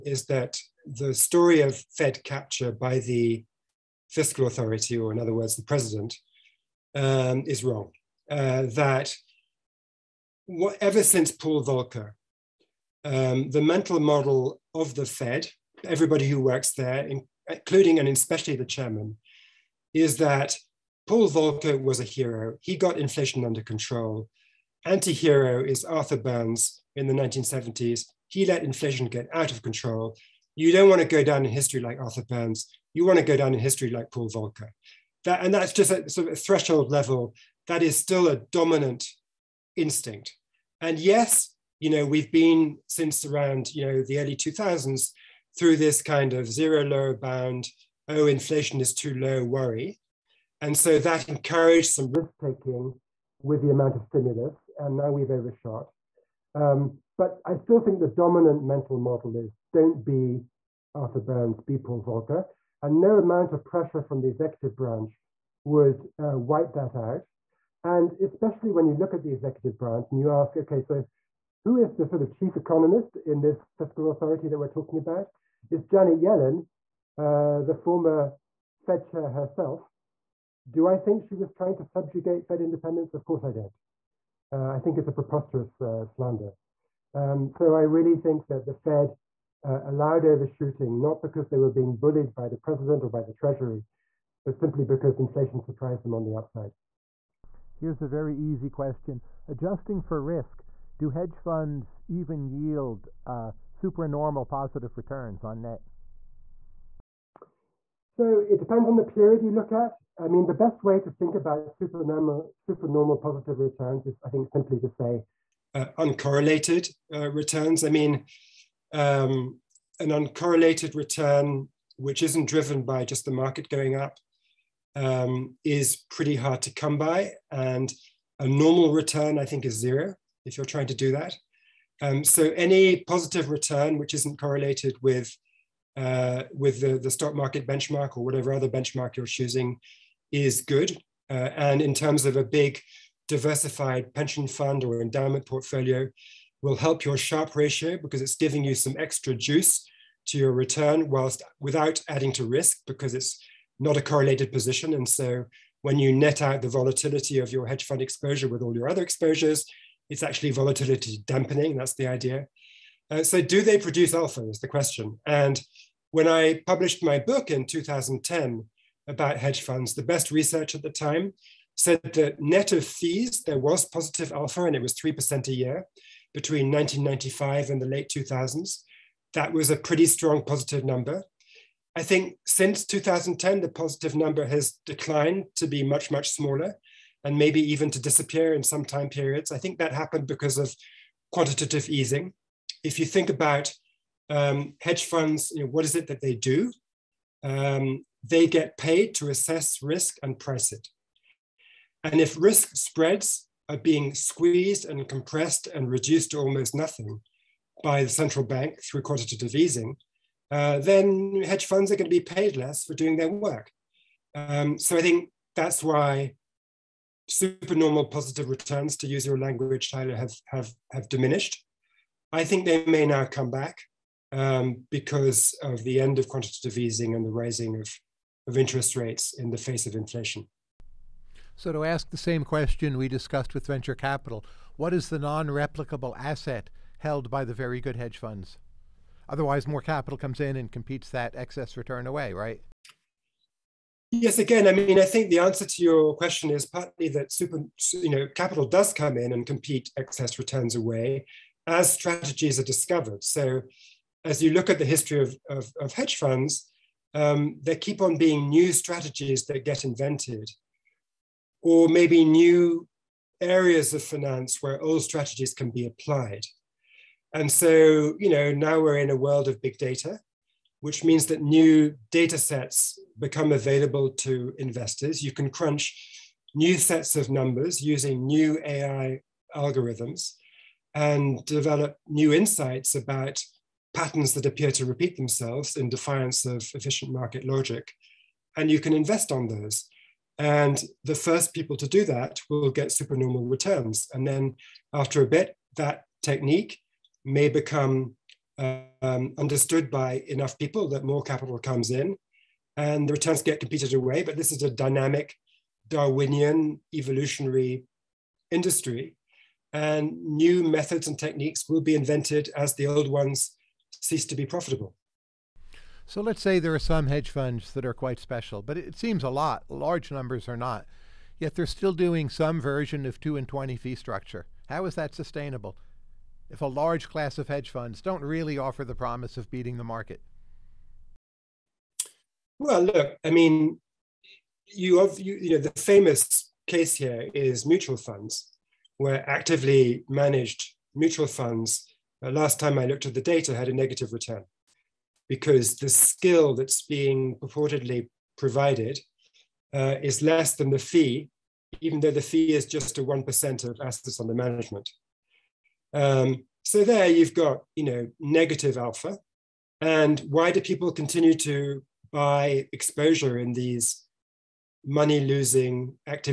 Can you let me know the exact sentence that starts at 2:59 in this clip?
That was a pretty strong positive number.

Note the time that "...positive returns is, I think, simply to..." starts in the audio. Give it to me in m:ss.
1:53.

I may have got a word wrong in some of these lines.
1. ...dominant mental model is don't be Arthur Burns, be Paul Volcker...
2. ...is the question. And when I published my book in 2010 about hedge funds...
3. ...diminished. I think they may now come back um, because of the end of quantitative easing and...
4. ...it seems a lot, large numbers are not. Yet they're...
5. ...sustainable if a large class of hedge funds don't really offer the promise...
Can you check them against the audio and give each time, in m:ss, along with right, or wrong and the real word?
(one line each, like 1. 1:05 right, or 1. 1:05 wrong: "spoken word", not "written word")
1. 0:58 right
2. 2:44 right
3. 3:41 right
4. 5:18 right
5. 5:25 right.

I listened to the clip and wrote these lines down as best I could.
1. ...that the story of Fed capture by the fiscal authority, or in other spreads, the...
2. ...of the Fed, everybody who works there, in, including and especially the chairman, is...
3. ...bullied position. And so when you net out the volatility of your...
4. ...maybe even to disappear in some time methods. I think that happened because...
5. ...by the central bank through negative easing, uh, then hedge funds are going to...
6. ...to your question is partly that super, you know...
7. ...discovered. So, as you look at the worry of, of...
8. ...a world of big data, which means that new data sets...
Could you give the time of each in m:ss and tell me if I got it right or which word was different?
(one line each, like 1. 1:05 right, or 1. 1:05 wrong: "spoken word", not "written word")
1. 0:00 wrong: "words", not "spreads"
2. 0:14 right
3. 2:34 wrong: "correlated", not "bullied"
4. 3:07 wrong: "periods", not "methods"
5. 3:27 wrong: "quantitative", not "negative"
6. 4:05 right
7. 4:12 wrong: "history", not "worry"
8. 4:29 right.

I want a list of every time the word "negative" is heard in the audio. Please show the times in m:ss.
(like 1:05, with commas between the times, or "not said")
5:43, 5:58.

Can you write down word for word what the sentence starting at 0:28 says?
He let inflation get out of control.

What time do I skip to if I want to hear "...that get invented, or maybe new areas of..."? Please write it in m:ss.
4:19.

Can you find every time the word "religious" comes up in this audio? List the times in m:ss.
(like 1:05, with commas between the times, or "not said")
not said.